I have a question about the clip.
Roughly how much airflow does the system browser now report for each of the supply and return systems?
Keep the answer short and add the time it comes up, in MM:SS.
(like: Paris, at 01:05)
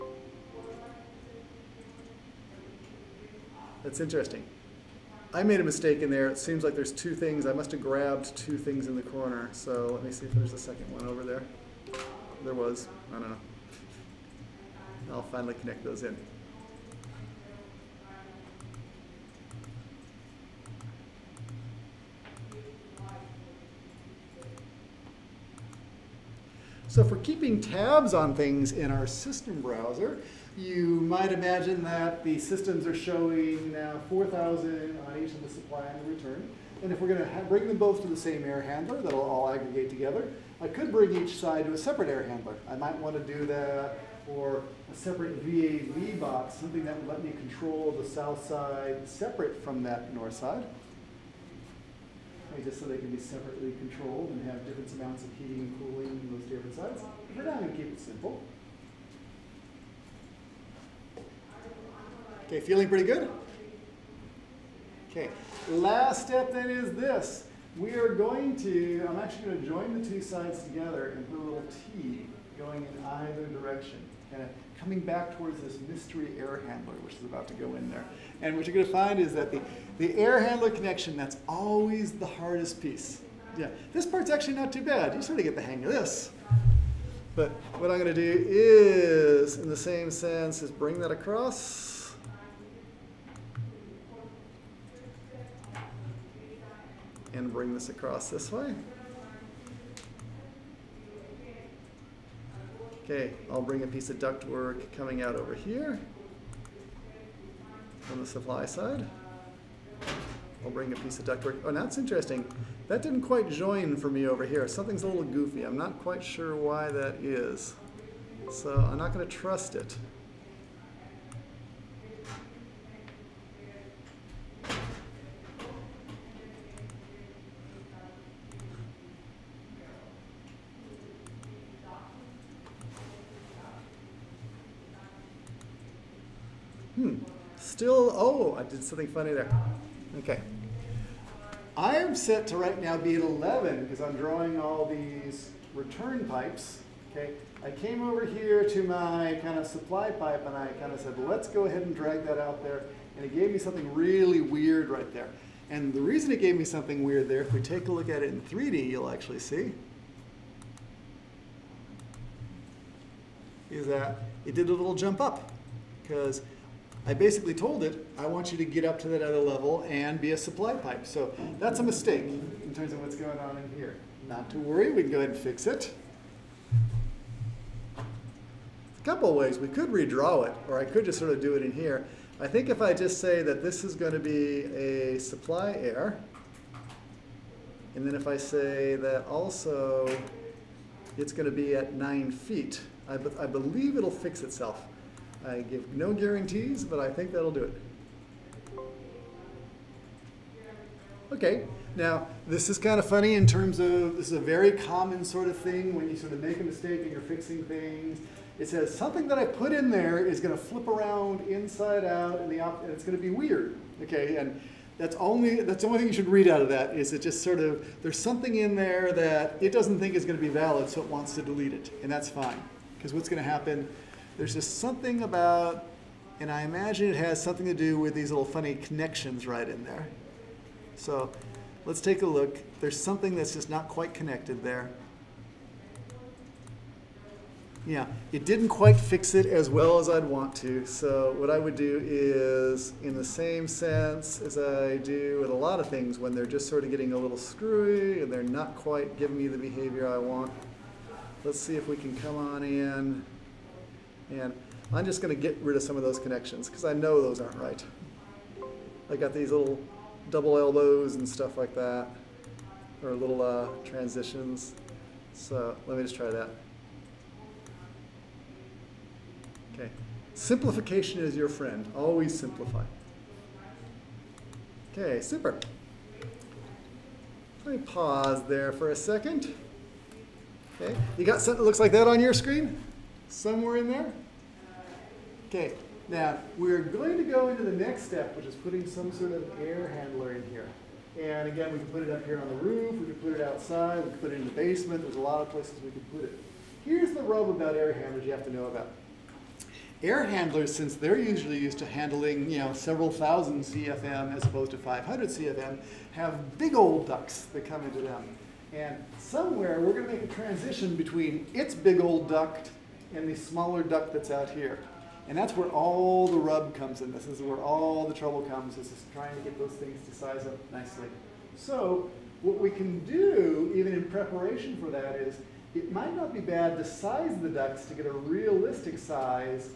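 4,000, at 00:34.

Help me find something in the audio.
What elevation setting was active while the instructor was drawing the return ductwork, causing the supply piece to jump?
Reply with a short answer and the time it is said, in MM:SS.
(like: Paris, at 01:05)
11, at 02:23.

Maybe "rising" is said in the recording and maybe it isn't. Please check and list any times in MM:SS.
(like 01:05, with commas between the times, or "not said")
not said.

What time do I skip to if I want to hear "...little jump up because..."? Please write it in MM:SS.
02:44.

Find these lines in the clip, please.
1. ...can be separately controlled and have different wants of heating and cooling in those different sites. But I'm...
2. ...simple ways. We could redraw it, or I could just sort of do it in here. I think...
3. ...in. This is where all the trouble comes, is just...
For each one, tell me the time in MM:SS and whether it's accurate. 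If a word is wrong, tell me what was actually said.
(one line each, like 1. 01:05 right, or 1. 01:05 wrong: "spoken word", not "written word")
1. 00:52 wrong: "amounts", not "wants"
2. 02:59 wrong: "couple", not "simple"
3. 05:16 right.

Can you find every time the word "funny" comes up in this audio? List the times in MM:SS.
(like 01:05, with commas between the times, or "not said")
02:19, 03:23, 03:48.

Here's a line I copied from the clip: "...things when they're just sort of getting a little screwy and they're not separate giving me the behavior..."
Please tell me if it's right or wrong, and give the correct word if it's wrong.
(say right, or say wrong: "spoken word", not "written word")
wrong: "quite", not "separate".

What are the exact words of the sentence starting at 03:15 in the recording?
I give no guarantees, but I think that'll do it.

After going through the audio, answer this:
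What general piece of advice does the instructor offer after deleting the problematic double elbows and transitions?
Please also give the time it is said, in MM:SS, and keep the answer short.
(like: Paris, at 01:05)
Simplification is your friend, at 04:30.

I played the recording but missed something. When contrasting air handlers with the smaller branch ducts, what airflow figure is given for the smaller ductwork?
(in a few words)
500 CFM.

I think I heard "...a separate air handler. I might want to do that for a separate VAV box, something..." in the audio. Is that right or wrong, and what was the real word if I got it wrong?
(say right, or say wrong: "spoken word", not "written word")
right.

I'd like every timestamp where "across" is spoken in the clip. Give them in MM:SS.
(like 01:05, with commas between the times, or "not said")
01:31, 01:37.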